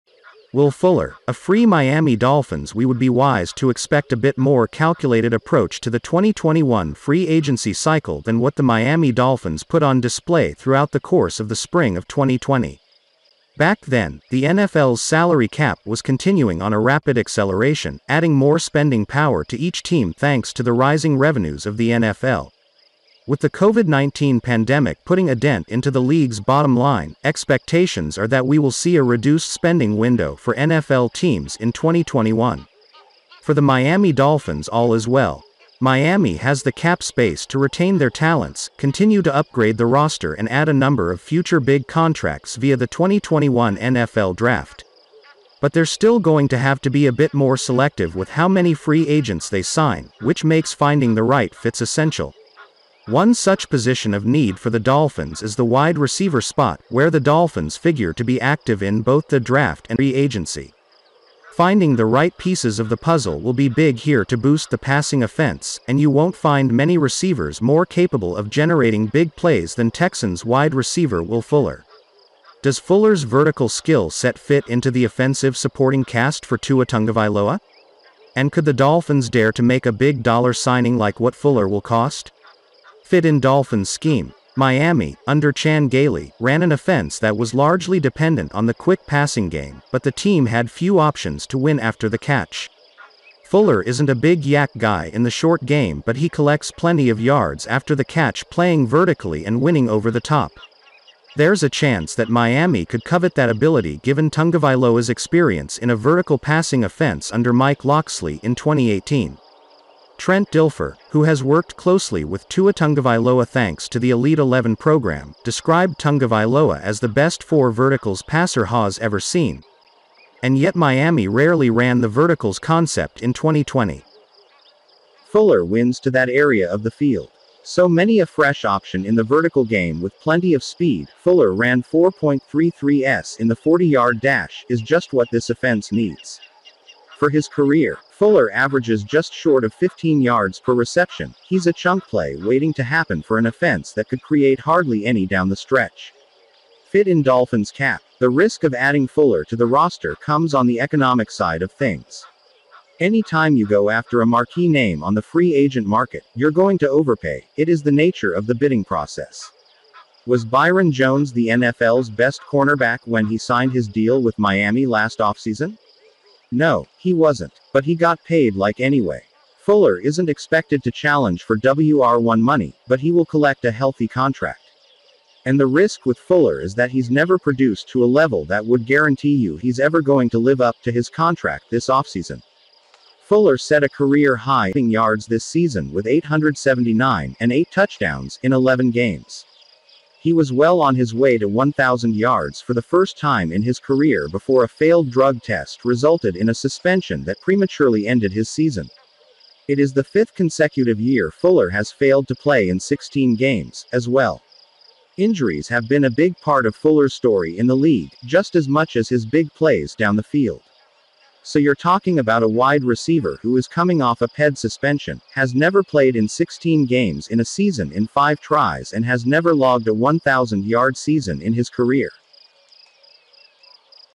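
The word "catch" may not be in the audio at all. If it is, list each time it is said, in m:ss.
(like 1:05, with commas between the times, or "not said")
1:32, 1:38.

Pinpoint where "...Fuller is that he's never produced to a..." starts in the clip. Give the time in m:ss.
2:56.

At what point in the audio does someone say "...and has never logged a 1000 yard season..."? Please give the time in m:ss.
3:38.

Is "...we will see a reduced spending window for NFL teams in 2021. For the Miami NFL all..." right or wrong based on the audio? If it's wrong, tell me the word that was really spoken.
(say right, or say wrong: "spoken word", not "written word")
wrong: "Dolphins", not "NFL".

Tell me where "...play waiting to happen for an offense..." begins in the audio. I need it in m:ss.
2:22.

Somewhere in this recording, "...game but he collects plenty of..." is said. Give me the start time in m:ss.
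1:35.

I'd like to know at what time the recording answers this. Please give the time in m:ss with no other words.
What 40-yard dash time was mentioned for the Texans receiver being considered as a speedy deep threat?
2:11.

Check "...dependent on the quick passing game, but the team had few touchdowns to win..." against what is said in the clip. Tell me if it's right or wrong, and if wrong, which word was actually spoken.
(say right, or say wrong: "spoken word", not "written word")
wrong: "options", not "touchdowns".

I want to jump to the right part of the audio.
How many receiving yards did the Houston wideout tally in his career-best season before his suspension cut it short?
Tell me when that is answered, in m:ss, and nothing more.
3:06.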